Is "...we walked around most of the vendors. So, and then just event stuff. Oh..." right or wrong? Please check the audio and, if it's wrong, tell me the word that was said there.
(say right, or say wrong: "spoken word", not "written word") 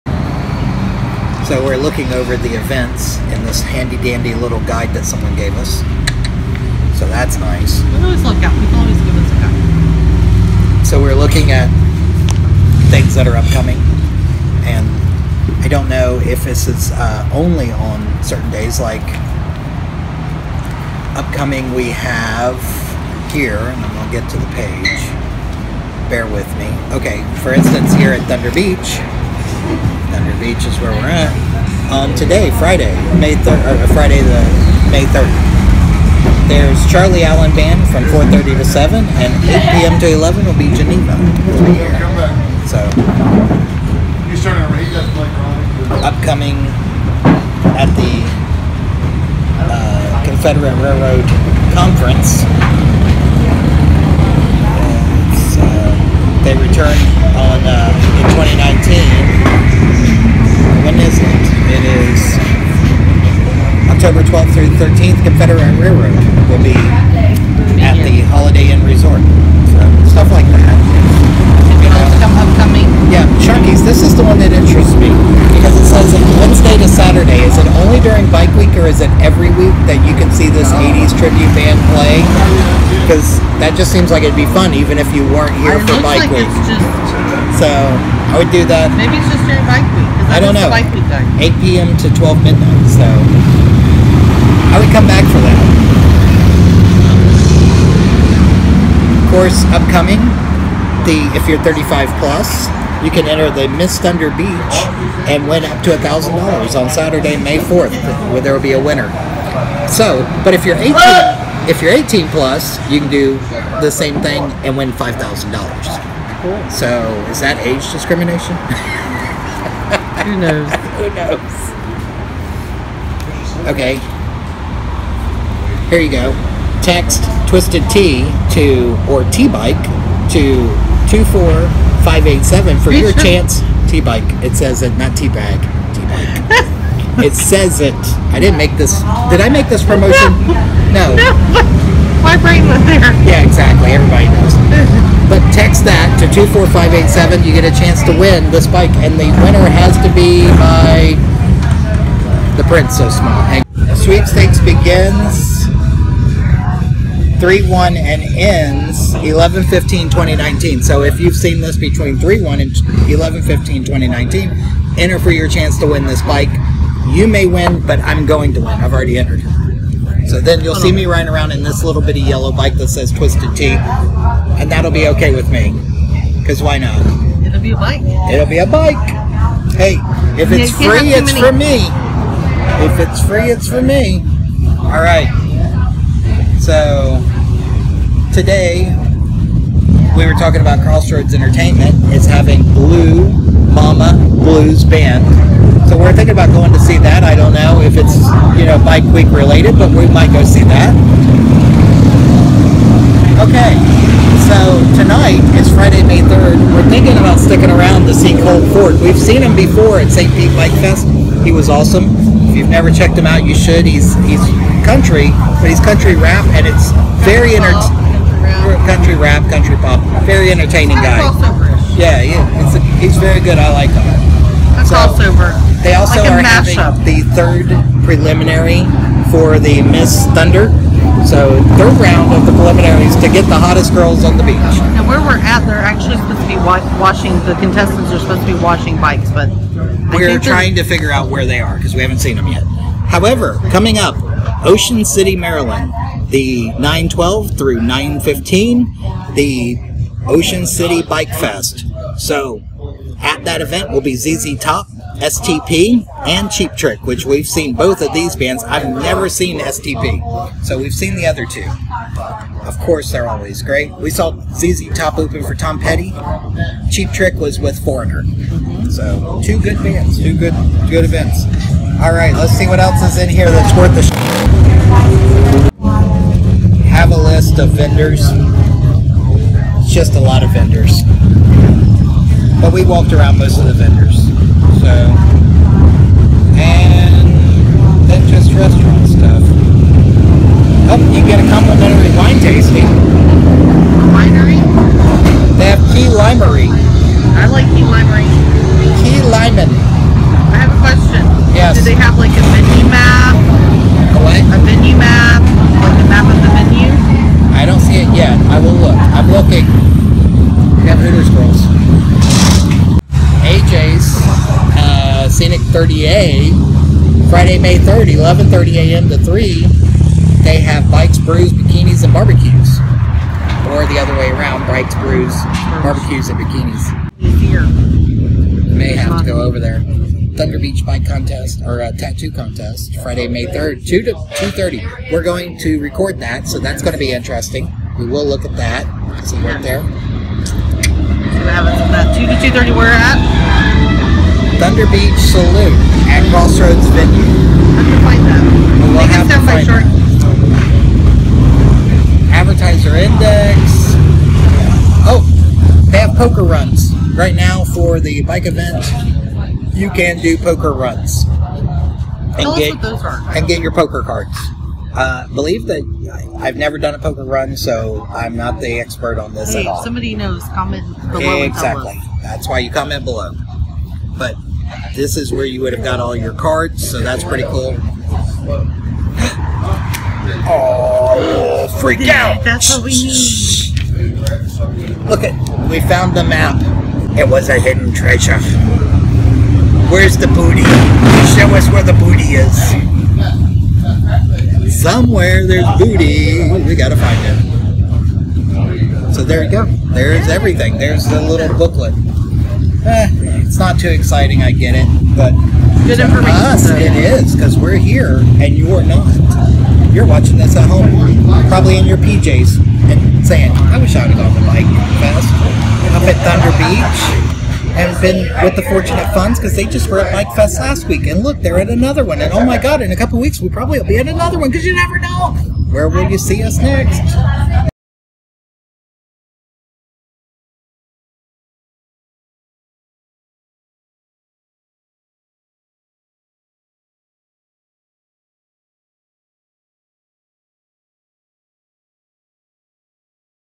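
wrong: "restaurant", not "event".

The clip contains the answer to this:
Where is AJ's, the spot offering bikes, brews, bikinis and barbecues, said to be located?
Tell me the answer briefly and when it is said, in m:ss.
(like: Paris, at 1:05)
Scenic 30A, at 5:15.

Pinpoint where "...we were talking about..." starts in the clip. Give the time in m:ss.
3:10.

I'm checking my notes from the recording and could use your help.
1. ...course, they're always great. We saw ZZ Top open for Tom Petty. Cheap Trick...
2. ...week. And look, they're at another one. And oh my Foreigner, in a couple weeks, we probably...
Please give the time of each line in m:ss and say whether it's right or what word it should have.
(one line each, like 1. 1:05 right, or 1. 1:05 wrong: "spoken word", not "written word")
1. 4:22 right
2. 7:00 wrong: "God", not "Foreigner".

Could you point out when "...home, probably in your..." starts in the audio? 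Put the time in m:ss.
6:50.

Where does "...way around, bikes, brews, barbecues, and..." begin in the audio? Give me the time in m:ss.
5:24.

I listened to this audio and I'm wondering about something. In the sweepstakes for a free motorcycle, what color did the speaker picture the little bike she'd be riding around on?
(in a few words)
Yellow.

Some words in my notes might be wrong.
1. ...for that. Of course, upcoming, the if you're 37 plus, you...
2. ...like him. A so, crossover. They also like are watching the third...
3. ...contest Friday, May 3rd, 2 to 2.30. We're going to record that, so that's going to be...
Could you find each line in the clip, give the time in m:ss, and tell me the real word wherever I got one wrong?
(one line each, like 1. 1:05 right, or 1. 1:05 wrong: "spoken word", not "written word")
1. 1:35 wrong: "35", not "37"
2. 3:43 wrong: "having", not "watching"
3. 5:32 right.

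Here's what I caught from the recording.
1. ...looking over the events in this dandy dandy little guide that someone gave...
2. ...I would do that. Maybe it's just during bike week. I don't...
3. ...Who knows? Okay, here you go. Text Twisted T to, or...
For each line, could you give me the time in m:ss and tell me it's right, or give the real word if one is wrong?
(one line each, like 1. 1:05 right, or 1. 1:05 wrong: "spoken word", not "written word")
1. 0:01 wrong: "handy", not "dandy"
2. 1:28 right
3. 2:03 right.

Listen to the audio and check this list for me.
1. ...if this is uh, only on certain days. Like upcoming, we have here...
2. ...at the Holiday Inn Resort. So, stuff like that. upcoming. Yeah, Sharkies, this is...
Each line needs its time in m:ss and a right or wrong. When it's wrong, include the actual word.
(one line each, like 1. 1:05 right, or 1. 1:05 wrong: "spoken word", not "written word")
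1. 0:16 right
2. 1:07 right.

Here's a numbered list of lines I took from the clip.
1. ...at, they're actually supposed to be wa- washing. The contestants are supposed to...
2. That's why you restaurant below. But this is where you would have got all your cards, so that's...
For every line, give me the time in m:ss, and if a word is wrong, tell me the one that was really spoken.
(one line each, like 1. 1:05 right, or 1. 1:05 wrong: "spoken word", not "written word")
1. 3:55 right
2. 6:12 wrong: "comment", not "restaurant".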